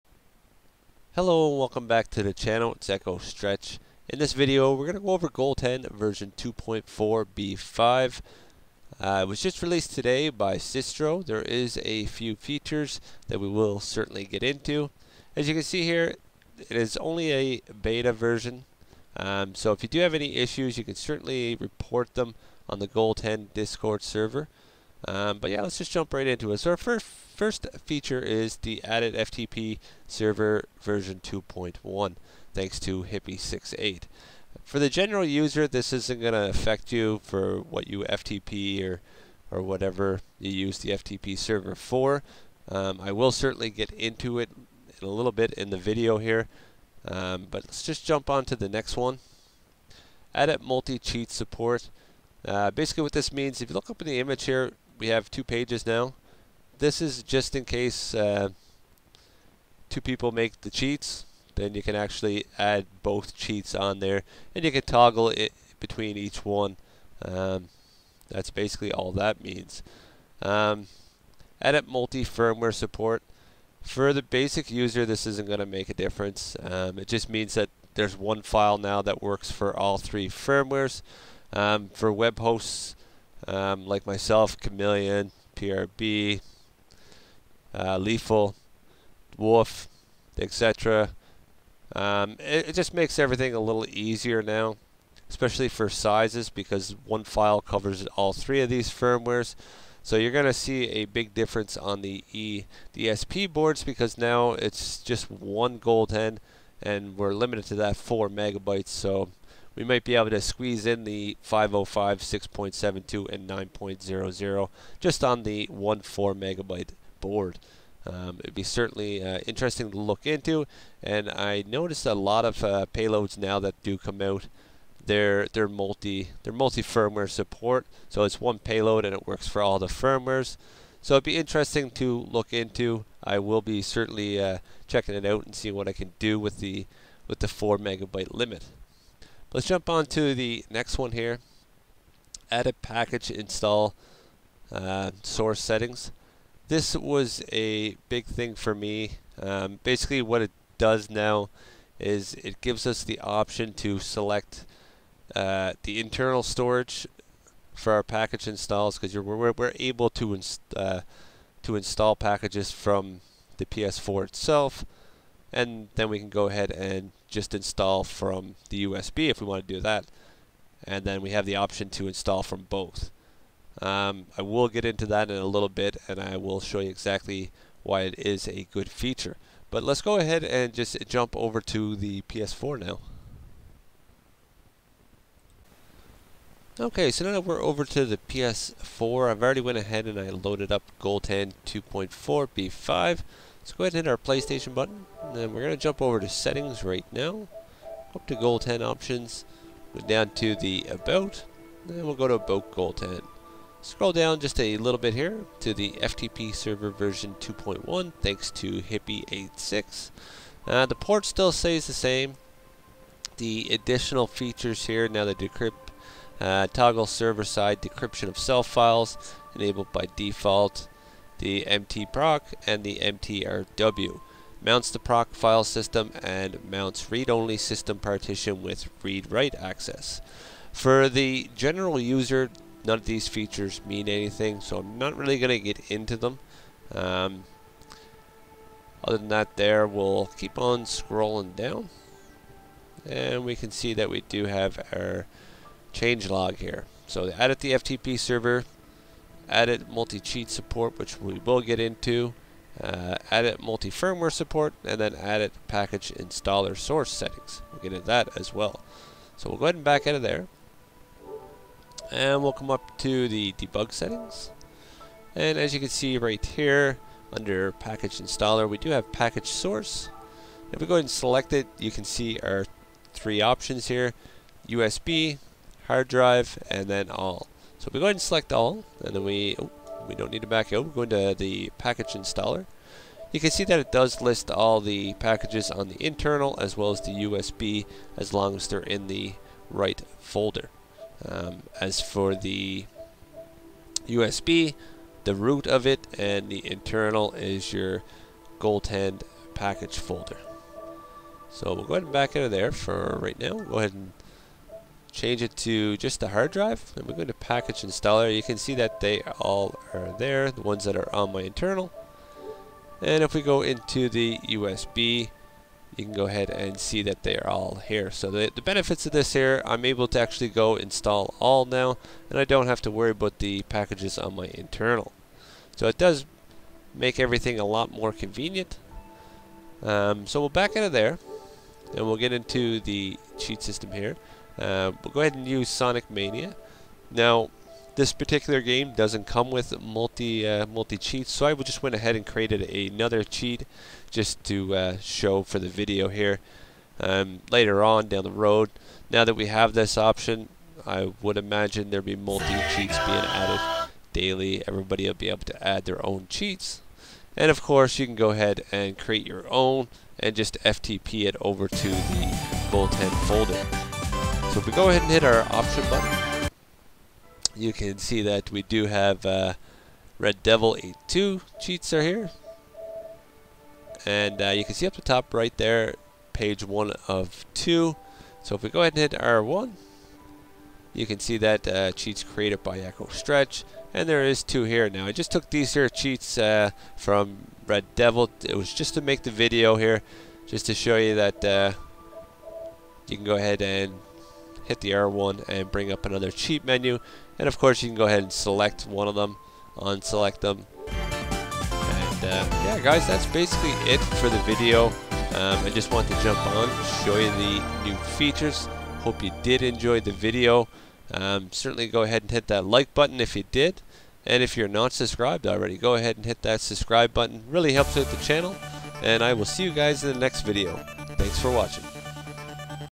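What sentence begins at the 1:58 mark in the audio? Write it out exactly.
Um, it'd be certainly uh, interesting to look into, and I noticed a lot of uh, payloads now that do come out.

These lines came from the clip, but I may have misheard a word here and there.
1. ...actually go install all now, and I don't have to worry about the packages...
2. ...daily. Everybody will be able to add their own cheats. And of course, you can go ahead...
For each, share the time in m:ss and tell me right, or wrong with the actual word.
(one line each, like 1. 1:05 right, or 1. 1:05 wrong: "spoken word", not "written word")
1. 5:20 right
2. 5:54 right.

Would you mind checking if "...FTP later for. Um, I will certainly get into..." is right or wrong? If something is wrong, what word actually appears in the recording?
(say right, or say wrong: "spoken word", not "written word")
wrong: "server", not "later".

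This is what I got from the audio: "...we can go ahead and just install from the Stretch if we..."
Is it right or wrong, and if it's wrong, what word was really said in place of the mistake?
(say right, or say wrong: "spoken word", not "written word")
wrong: "USB", not "Stretch".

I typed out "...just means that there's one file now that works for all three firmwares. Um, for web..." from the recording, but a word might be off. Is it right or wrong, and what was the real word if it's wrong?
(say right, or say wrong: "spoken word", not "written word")
right.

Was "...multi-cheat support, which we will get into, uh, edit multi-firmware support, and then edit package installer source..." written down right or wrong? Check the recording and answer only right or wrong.
right.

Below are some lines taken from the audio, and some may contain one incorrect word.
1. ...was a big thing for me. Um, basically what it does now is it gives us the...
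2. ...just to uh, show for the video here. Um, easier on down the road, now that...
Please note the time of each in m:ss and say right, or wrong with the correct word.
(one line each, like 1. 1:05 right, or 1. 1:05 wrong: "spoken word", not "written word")
1. 2:26 right
2. 5:44 wrong: "later", not "easier".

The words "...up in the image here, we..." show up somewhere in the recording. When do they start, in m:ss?
0:53.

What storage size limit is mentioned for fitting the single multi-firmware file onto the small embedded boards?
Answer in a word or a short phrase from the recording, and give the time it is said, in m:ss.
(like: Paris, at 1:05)
4 megabytes, at 1:47.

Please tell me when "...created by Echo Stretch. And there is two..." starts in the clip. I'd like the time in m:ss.
6:22.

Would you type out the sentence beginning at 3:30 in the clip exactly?
Uh, the port still stays the same.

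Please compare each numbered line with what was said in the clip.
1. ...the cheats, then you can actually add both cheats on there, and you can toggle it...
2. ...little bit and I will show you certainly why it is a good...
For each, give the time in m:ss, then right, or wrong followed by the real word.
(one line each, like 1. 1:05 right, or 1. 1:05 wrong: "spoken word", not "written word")
1. 1:00 right
2. 2:55 wrong: "exactly", not "certainly".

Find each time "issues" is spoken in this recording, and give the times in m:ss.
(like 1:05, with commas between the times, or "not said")
0:20.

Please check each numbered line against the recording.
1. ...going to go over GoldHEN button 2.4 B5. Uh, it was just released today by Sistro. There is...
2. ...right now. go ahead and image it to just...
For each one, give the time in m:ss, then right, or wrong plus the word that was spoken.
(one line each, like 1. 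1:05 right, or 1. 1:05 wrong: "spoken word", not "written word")
1. 0:04 wrong: "version", not "button"
2. 5:03 wrong: "change", not "image".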